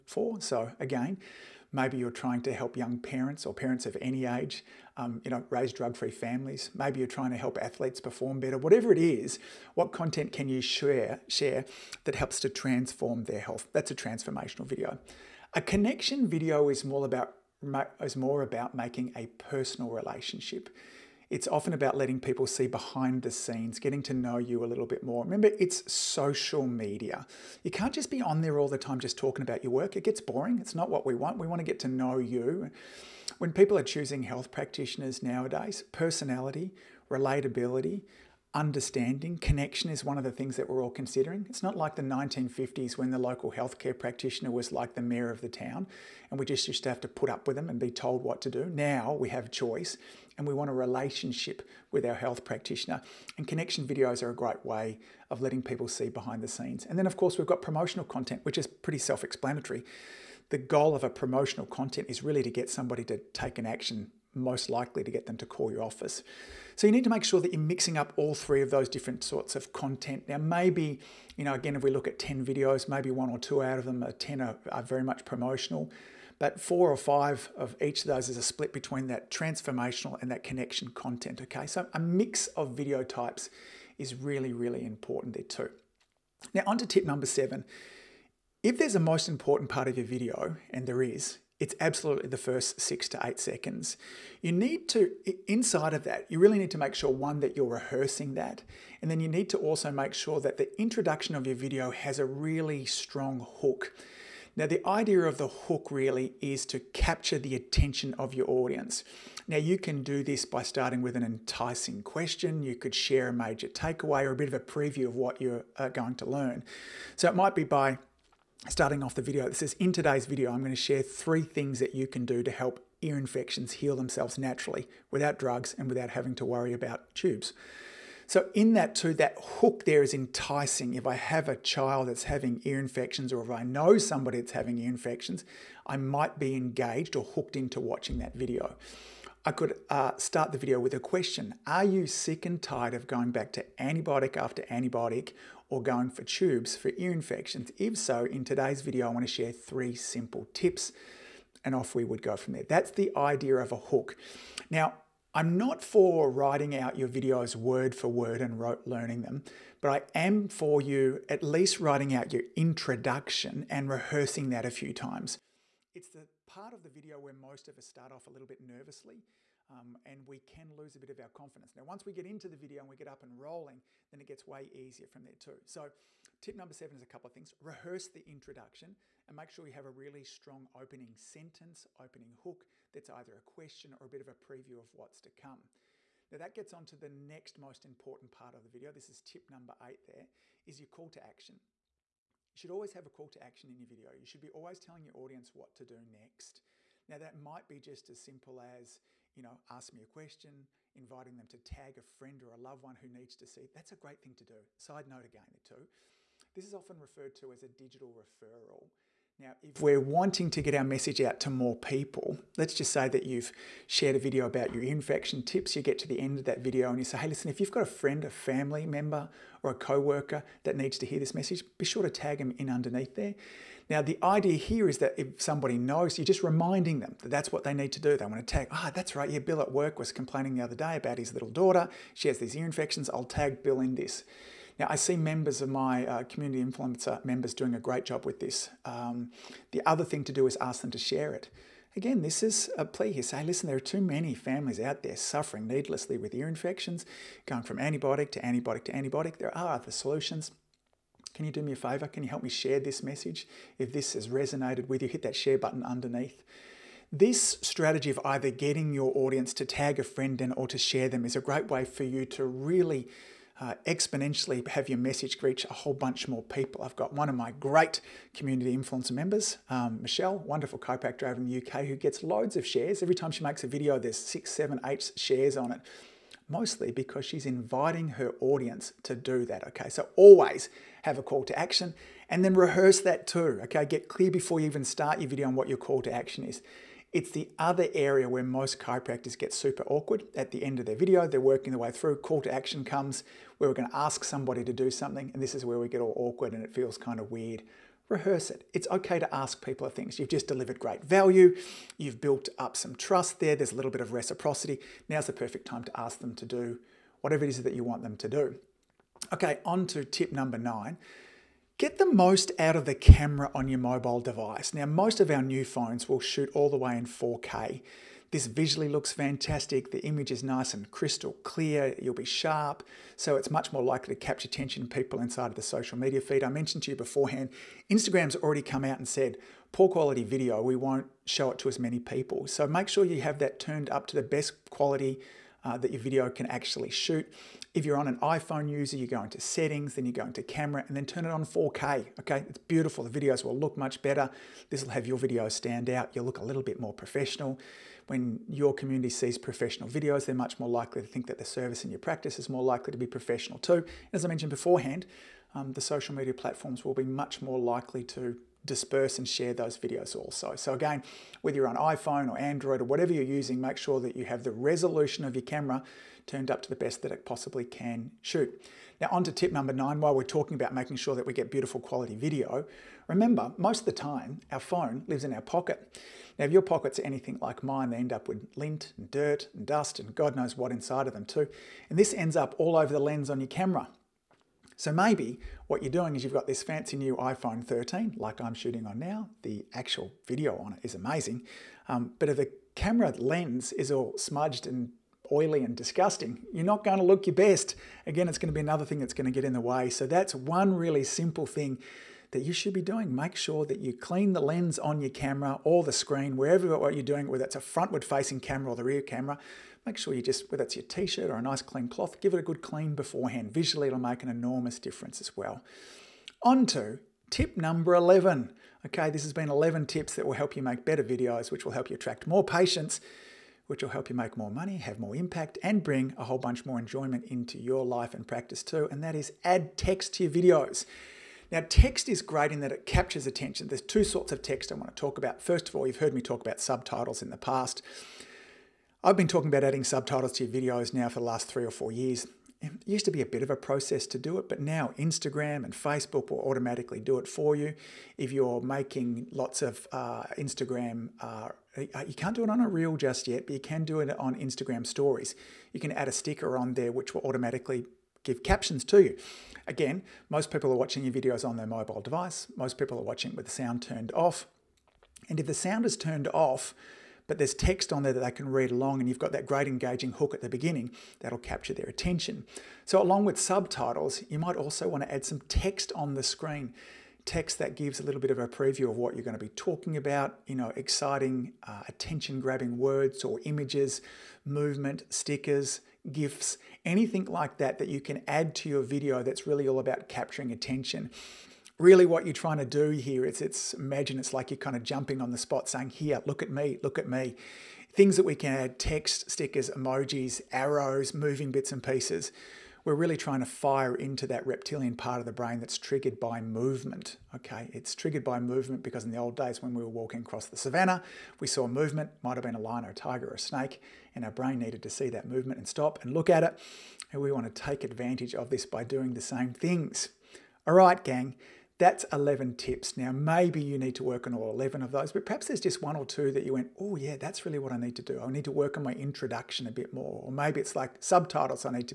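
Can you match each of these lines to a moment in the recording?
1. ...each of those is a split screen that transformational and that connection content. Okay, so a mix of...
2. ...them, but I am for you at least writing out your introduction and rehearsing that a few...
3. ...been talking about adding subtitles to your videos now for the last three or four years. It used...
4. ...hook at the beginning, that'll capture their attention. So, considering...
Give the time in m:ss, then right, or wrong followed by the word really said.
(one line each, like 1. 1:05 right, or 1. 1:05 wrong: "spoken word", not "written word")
1. 1:17 wrong: "between", not "screen"
2. 2:39 right
3. 7:19 right
4. 7:50 wrong: "along", not "considering".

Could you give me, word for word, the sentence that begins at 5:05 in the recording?
Now's the perfect time to ask them to do whatever it is that you want them to do.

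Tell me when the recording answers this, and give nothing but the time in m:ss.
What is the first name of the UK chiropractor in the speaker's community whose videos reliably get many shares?
4:30.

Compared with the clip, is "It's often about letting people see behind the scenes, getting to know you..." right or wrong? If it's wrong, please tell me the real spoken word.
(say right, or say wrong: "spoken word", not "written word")
right.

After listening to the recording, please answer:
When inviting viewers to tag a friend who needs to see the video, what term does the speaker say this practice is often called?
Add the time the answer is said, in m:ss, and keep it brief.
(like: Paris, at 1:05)
digital referral, at 3:27.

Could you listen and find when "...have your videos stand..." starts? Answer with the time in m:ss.
5:44.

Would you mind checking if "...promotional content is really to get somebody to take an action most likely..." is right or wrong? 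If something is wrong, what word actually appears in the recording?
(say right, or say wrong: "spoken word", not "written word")
right.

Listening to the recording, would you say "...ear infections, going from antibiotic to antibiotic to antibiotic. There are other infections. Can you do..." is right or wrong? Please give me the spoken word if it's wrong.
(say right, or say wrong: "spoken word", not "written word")
wrong: "solutions", not "infections".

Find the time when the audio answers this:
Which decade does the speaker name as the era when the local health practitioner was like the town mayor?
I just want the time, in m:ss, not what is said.
0:42.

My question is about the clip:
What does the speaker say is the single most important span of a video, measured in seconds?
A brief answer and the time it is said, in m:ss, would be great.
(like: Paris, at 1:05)
first 6 to 8 seconds, at 1:32.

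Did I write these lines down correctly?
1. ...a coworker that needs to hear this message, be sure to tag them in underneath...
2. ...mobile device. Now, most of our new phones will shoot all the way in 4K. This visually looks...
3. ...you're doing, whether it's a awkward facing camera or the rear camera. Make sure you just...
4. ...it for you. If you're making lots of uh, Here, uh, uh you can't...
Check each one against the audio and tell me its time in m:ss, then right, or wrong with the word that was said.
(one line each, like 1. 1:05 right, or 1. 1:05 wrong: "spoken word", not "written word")
1. 3:39 right
2. 5:13 right
3. 6:46 wrong: "frontward", not "awkward"
4. 7:27 wrong: "Instagram", not "Here".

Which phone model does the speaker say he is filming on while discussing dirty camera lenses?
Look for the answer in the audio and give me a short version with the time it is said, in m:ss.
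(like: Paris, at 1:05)
iPhone 13, at 6:27.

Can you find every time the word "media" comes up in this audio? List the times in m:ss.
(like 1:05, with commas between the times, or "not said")
0:26, 5:25, 5:56.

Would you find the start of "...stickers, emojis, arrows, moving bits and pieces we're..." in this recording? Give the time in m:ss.
8:19.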